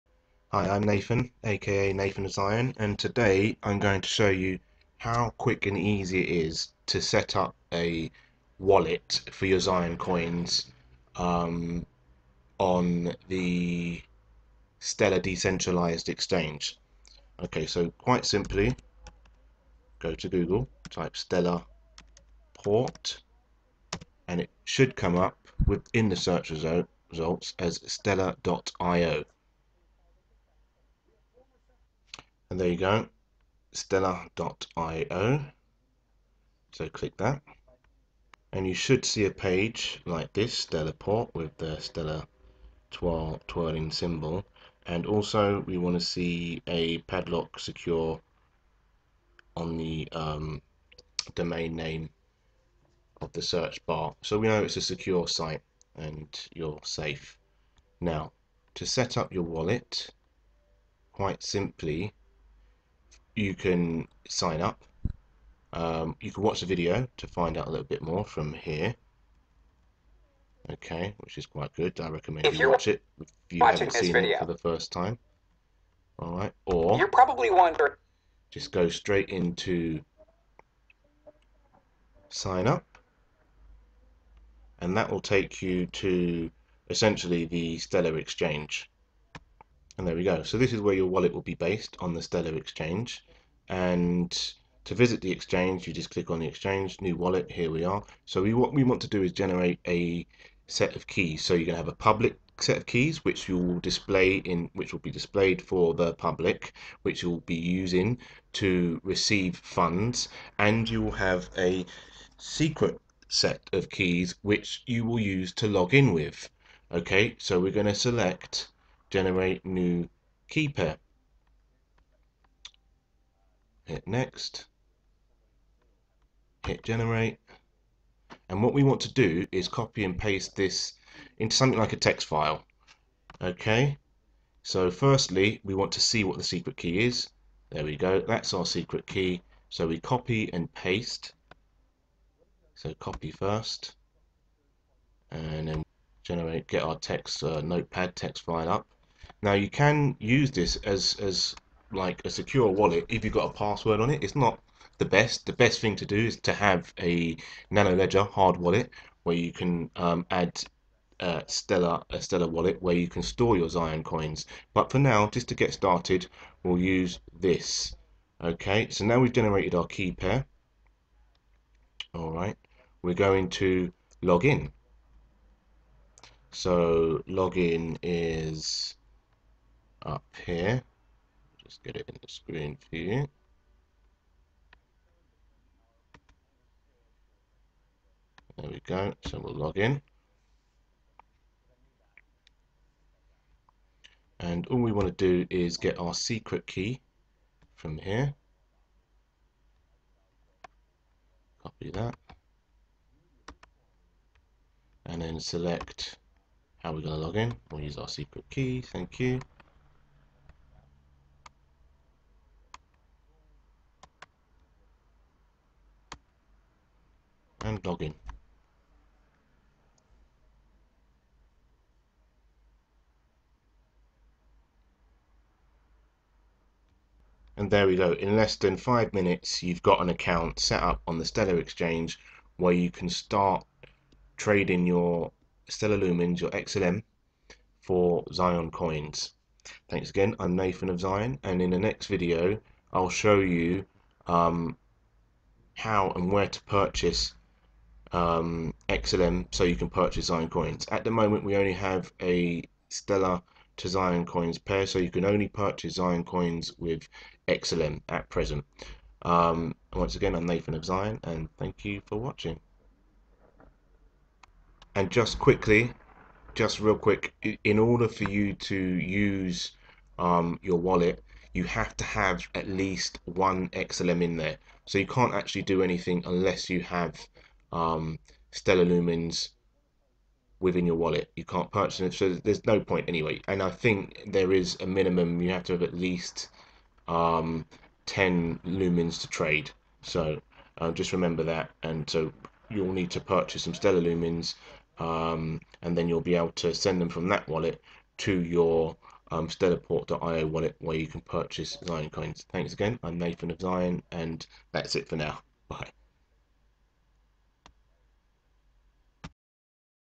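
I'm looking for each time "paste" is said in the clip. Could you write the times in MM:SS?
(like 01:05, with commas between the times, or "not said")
02:10, 02:20.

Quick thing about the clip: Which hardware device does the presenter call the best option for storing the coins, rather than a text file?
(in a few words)
Nano Ledger.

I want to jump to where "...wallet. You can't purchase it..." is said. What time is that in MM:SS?
04:40.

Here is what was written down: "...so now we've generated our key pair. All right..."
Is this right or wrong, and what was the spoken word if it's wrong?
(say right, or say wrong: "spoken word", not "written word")
right.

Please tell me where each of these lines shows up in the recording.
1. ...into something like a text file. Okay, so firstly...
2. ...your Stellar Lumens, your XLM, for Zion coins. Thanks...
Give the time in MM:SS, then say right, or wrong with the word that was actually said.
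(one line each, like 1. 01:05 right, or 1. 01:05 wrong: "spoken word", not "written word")
1. 02:11 right
2. 03:54 right.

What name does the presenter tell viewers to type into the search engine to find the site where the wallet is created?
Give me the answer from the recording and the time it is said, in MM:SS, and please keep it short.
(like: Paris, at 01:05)
Stellar Port, at 00:21.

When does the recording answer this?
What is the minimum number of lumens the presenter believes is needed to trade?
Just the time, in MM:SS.
04:48.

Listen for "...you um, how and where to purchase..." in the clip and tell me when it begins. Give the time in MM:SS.
04:03.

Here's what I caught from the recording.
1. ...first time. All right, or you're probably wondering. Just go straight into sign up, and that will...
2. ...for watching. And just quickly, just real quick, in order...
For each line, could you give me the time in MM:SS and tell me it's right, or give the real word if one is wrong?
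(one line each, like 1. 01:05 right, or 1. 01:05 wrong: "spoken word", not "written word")
1. 01:14 right
2. 04:22 right.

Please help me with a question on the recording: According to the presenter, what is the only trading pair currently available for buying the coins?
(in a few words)
Stellar to Zion coins.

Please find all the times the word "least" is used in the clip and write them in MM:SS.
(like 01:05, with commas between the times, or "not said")
04:32, 04:45.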